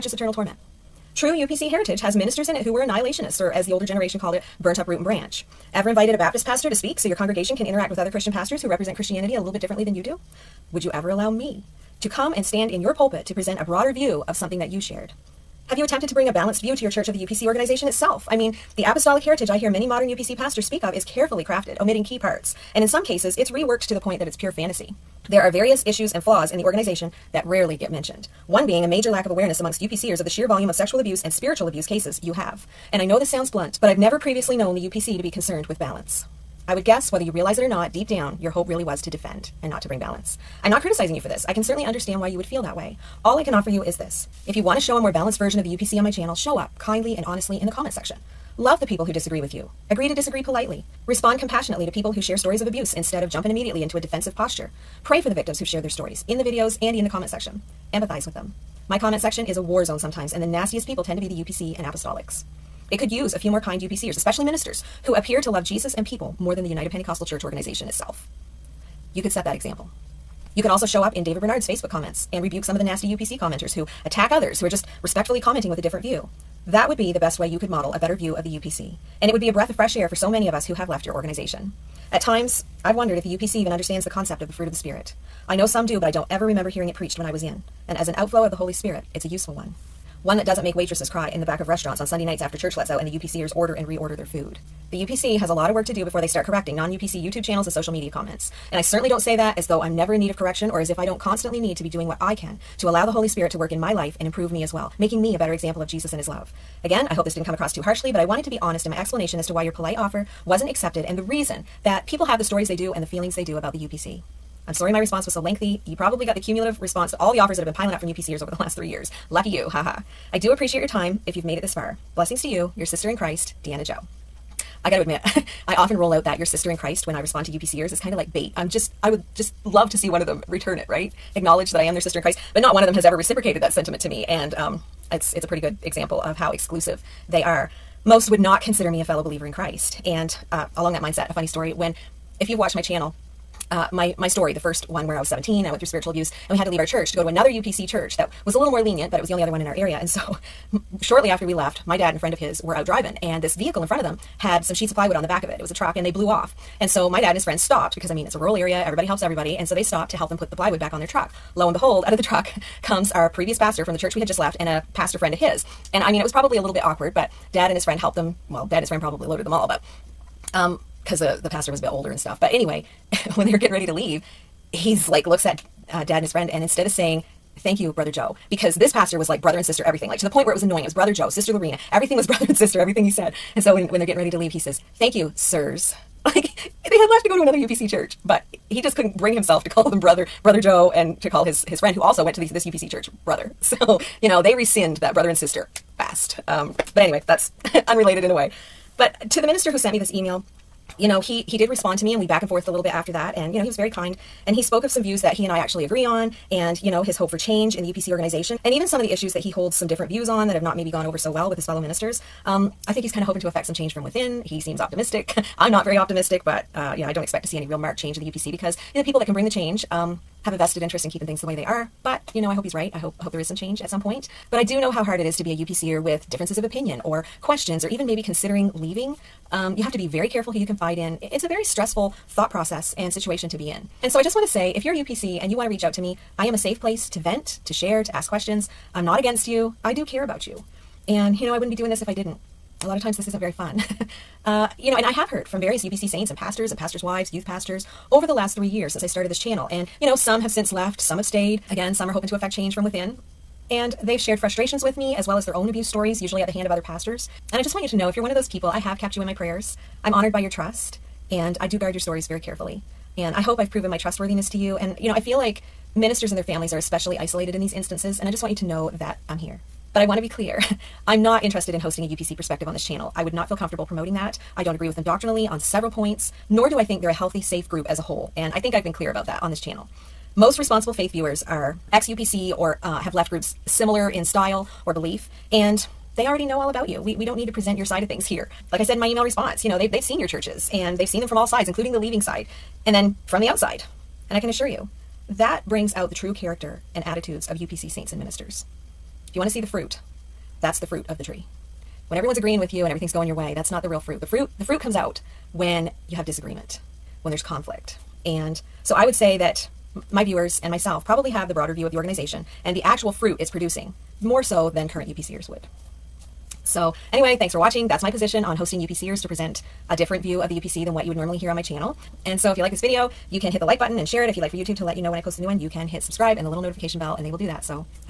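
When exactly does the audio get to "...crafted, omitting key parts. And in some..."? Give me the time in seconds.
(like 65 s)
21 s.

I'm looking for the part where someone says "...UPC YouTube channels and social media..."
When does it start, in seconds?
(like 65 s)
96 s.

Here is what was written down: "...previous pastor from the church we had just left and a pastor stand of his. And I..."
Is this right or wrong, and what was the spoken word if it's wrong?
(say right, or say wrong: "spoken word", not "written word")
wrong: "friend", not "stand".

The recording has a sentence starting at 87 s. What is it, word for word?
And as an outflow of the Holy Spirit, it's a useful one.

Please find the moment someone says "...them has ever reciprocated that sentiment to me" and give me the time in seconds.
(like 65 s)
132 s.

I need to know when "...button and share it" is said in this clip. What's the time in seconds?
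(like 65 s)
323 s.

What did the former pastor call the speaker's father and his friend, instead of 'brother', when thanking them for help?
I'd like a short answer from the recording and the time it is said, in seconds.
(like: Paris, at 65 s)
Sirs, at 185 s.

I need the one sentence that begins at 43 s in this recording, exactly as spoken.
All I can offer you is this.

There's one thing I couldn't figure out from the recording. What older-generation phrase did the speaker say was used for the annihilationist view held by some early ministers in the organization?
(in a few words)
Burnt up root and branch.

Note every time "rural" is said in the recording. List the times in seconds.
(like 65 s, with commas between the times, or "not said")
158 s.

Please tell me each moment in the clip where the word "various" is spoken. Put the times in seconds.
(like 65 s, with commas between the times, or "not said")
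25 s, 245 s.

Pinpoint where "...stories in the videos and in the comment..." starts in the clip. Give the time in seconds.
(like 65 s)
55 s.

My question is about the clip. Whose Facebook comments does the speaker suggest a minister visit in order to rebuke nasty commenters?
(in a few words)
David Bernard.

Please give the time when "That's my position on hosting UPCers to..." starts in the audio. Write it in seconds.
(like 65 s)
317 s.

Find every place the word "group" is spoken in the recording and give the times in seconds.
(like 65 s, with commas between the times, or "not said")
277 s, 283 s.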